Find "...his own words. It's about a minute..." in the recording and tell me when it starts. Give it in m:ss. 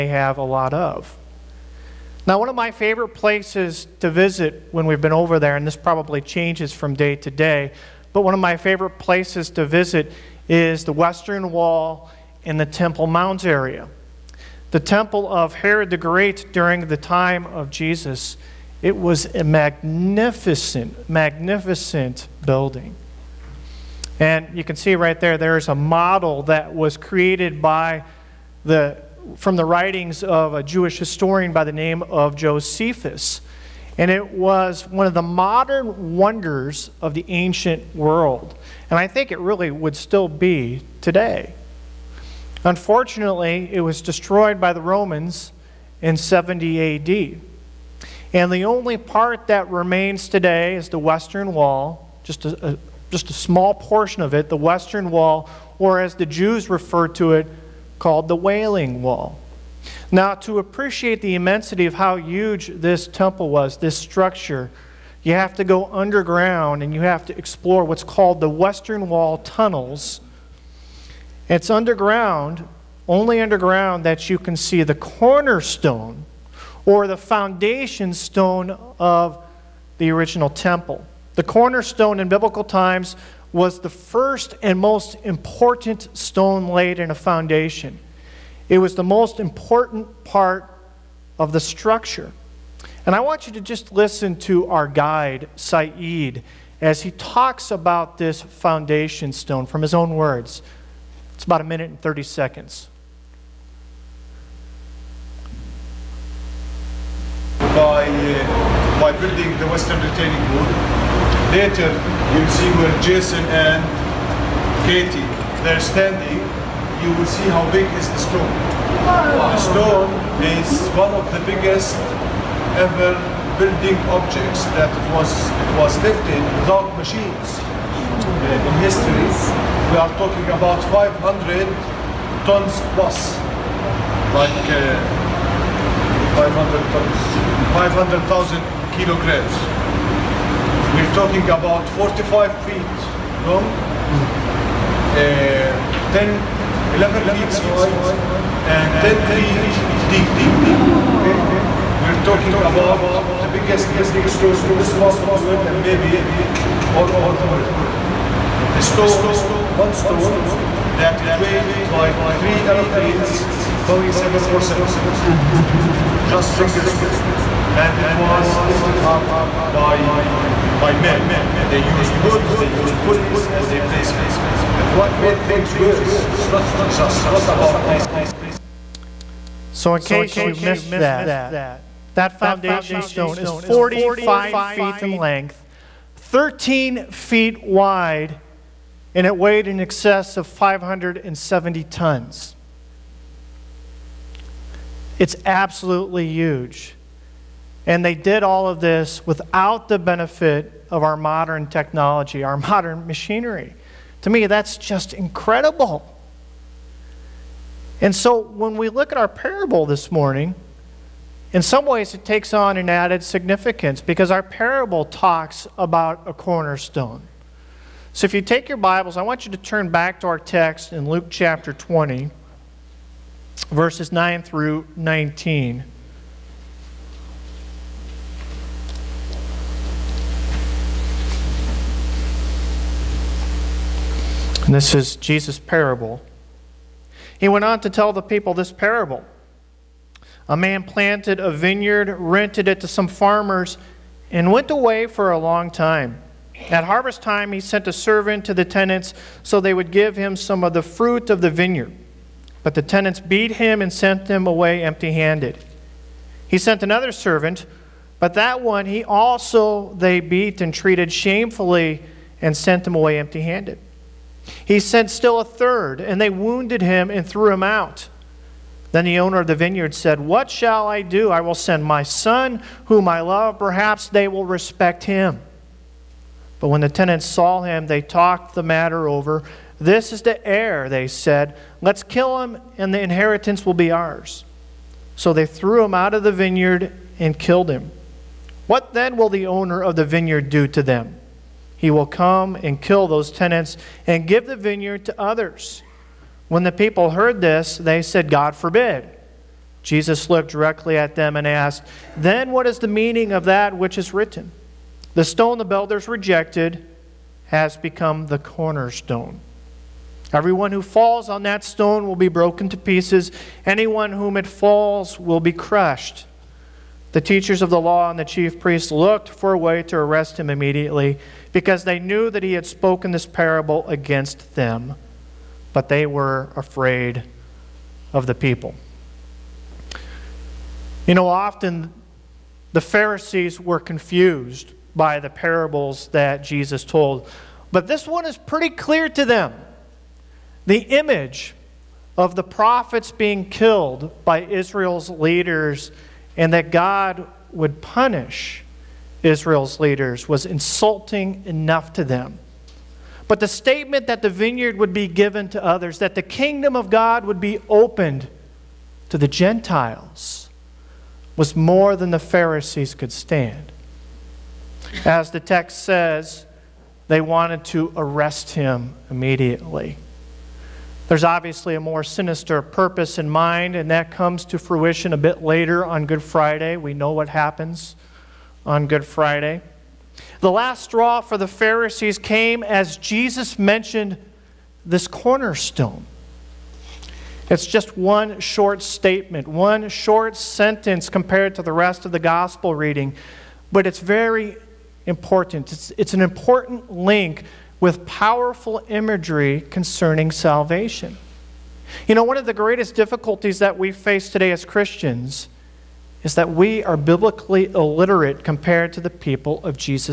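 1:39.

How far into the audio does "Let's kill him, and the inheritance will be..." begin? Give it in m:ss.
4:41.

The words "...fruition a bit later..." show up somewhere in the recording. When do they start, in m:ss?
6:14.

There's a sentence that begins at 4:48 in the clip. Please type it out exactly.
What then will the owner of the vineyard do to them?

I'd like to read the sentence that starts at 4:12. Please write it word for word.
But the tenants beat him and sent him away empty handed.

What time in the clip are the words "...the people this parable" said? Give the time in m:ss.
3:58.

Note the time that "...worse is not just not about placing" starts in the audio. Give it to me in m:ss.
2:55.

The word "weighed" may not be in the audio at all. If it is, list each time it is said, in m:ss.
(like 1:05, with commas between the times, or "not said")
2:41, 3:09.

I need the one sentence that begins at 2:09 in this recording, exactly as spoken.
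We are talking about 500 tons plus, like uh, 500 tons, 500,000 kilograms.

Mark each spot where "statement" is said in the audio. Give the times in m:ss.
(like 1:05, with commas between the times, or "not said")
5:53, 6:28.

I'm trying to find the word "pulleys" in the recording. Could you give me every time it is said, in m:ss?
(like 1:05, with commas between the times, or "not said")
2:53.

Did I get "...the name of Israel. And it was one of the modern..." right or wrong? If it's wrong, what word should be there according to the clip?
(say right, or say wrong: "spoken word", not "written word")
wrong: "Josephus", not "Israel".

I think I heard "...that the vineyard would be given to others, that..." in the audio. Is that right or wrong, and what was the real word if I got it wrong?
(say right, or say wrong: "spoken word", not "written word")
right.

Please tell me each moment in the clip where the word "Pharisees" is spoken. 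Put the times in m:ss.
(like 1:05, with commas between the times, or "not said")
5:32, 6:02, 6:21.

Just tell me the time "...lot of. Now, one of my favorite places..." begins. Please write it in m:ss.
0:00.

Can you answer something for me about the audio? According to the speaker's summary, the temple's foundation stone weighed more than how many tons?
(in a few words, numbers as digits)
570.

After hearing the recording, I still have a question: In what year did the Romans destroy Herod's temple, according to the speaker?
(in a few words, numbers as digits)
70 AD.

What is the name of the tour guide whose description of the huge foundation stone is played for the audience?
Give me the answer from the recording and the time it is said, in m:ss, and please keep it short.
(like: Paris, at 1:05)
Saeed, at 1:35.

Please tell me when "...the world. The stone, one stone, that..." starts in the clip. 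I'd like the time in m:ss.
2:37.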